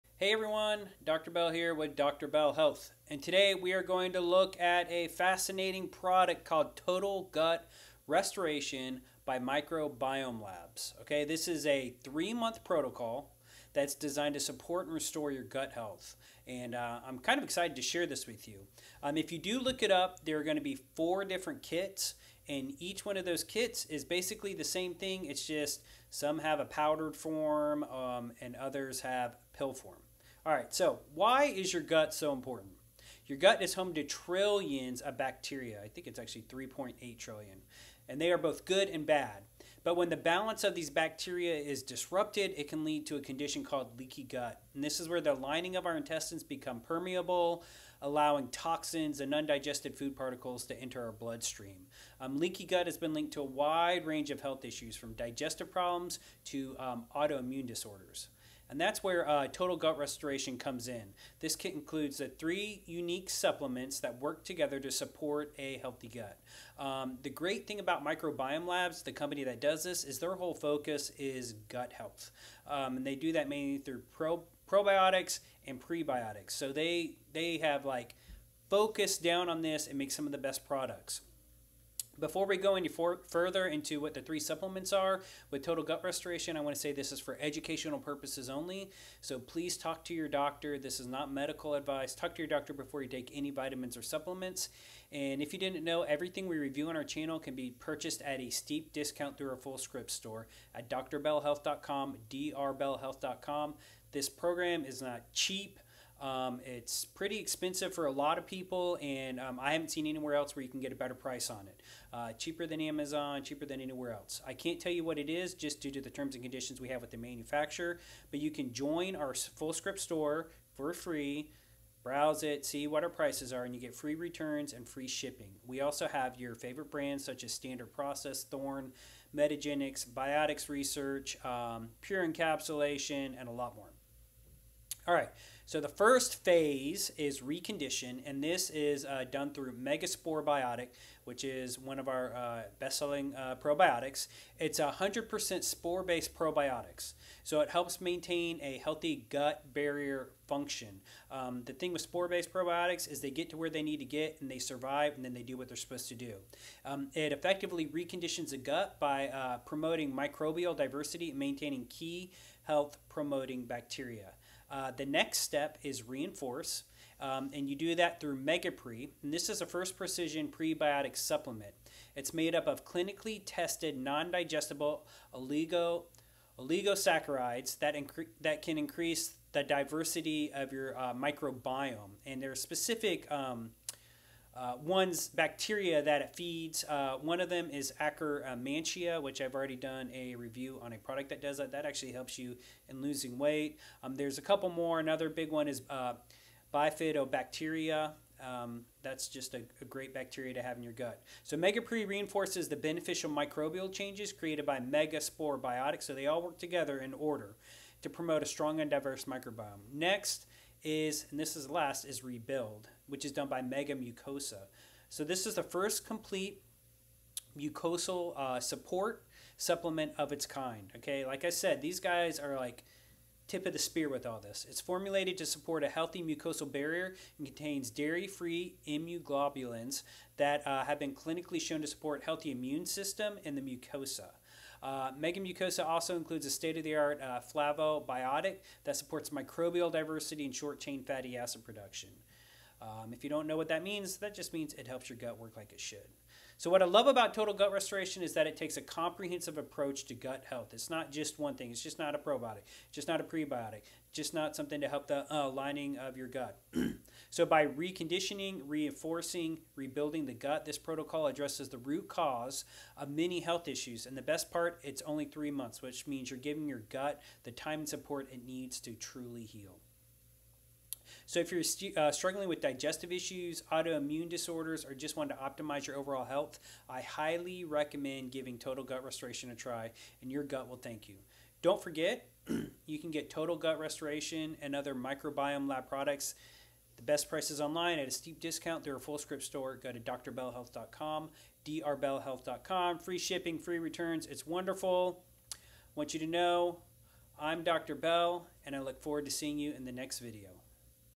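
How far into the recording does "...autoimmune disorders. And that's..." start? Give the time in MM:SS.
00:57.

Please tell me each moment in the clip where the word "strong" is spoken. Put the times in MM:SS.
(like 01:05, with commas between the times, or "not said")
03:28.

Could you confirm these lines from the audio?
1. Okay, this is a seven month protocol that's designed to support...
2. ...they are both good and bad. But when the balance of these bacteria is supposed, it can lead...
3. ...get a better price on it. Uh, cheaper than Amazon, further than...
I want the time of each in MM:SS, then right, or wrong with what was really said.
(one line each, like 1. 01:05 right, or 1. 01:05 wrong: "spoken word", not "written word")
1. 00:11 wrong: "three", not "seven"
2. 00:38 wrong: "disrupted", not "supposed"
3. 01:50 wrong: "cheaper", not "further".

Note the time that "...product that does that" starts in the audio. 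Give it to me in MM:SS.
03:10.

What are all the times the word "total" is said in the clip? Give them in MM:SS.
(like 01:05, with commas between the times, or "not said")
00:06, 00:59, 01:25, 04:07, 04:38, 04:43.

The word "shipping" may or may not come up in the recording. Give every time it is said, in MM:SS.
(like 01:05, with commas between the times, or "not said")
02:05, 04:53.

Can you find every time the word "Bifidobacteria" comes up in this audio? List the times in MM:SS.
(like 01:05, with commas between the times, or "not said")
03:16.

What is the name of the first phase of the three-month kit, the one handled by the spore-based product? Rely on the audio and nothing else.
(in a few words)
Recondition.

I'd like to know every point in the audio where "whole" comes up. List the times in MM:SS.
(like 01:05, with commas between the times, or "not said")
01:10.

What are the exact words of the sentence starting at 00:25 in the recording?
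It's just some have a powdered form um, and others have pill form.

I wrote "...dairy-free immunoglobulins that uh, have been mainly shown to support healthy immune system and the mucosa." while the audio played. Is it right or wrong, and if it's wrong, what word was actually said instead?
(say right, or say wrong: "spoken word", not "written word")
wrong: "clinically", not "mainly".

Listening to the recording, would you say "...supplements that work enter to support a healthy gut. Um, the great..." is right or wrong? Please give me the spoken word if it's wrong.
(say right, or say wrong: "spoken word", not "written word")
wrong: "together", not "enter".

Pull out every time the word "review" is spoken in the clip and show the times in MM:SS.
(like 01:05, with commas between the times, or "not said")
01:36, 03:10.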